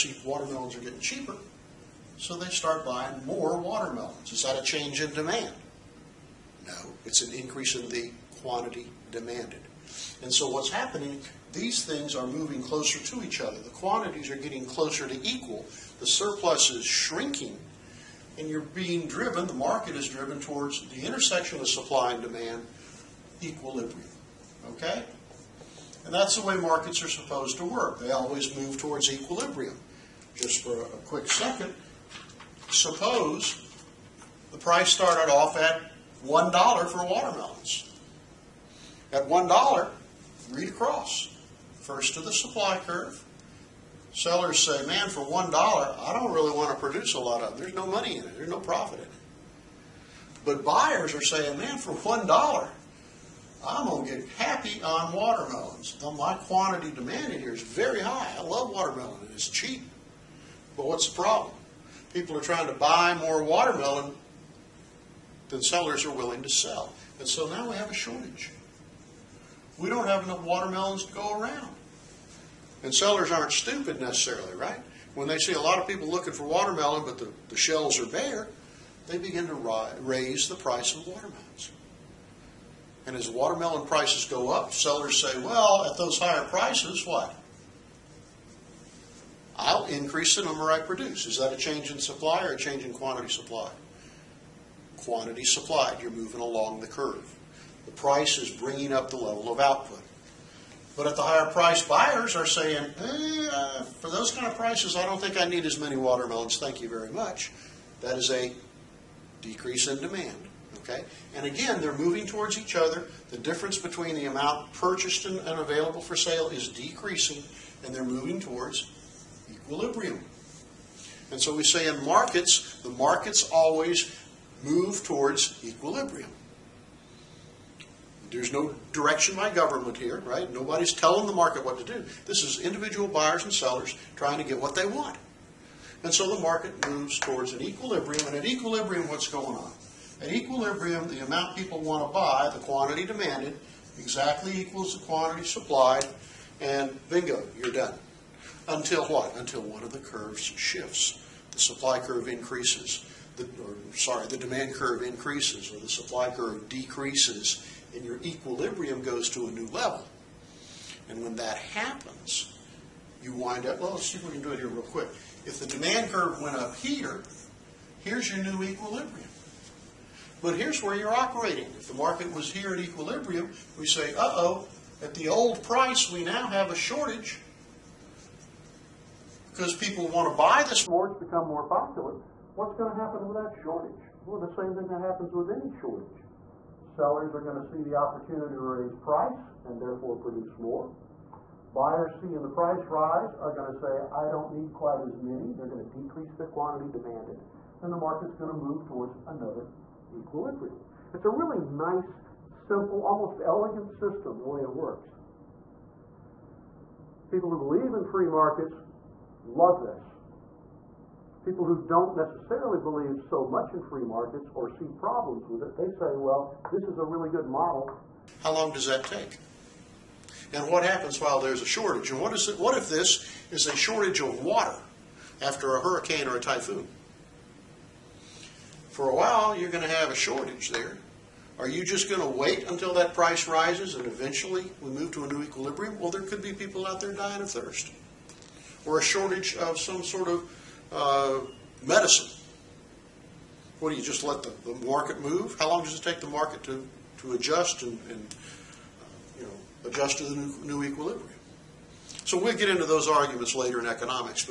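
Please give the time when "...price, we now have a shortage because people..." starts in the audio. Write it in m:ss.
2:55.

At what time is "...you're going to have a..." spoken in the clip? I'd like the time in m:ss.
3:49.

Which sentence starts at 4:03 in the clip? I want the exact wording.
What do you just let the, the, market move?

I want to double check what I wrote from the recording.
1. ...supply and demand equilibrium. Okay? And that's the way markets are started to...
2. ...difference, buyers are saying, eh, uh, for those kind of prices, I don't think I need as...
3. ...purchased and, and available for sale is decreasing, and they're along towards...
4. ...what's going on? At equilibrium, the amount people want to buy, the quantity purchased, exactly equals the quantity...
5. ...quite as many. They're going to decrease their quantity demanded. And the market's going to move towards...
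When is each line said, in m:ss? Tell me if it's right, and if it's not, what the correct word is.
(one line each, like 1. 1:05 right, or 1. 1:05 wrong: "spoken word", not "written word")
1. 0:21 wrong: "supposed", not "started"
2. 1:41 wrong: "price", not "difference"
3. 1:54 wrong: "moving", not "along"
4. 2:19 wrong: "demanded", not "purchased"
5. 3:14 right.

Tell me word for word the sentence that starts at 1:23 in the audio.
And as watermelon prices go up, sellers say, well, at those higher prices, what?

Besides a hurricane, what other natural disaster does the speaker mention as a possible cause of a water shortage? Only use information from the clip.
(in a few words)
typhoon.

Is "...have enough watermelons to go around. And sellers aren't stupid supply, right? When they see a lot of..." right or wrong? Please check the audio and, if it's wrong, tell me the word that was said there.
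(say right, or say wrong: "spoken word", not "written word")
wrong: "necessarily", not "supply".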